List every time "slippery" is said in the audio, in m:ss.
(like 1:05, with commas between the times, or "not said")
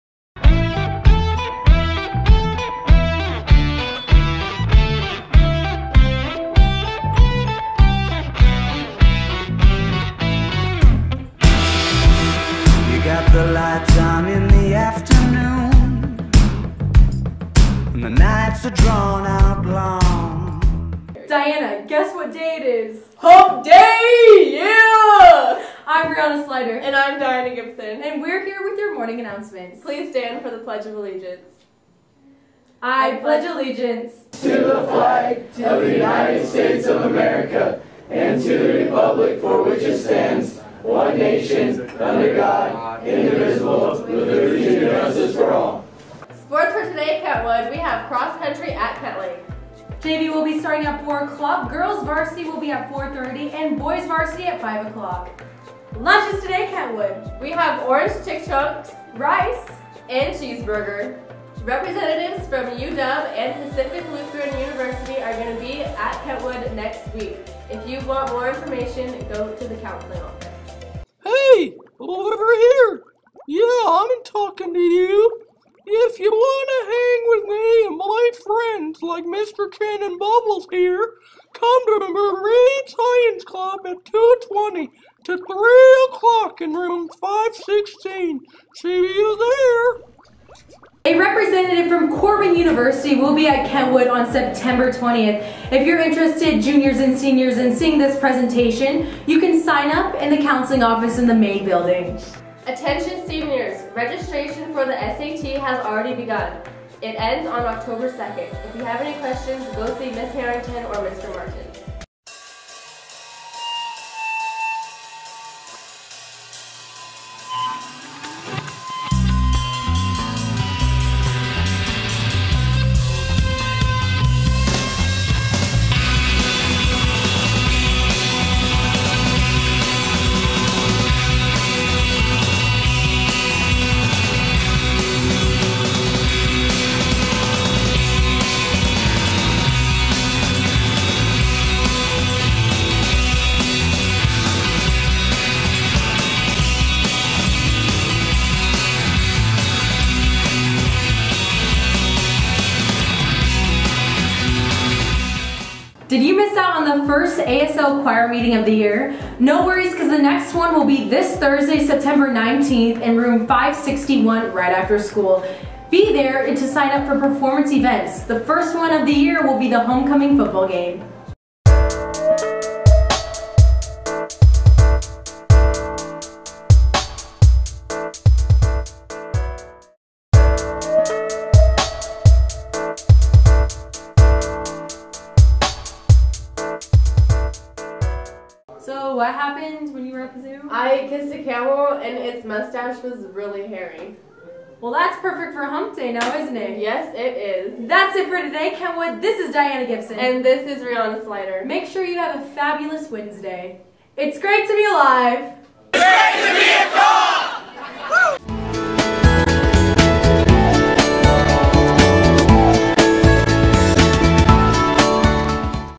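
not said.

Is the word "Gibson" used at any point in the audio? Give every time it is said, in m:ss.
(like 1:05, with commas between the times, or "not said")
0:27, 3:19.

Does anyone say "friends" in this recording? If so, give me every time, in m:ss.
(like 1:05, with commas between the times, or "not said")
1:18.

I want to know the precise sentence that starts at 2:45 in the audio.
Be there to sign up for performance events.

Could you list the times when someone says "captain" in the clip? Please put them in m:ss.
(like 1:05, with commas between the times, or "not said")
not said.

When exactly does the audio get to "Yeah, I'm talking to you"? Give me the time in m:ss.
1:13.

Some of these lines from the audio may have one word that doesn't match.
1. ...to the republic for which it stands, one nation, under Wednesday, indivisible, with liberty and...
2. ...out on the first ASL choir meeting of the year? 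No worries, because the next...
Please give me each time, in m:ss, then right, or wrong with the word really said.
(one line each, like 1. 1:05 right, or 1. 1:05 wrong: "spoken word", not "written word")
1. 0:38 wrong: "God", not "Wednesday"
2. 2:36 right.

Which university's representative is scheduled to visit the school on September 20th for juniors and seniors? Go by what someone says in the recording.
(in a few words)
Corban University.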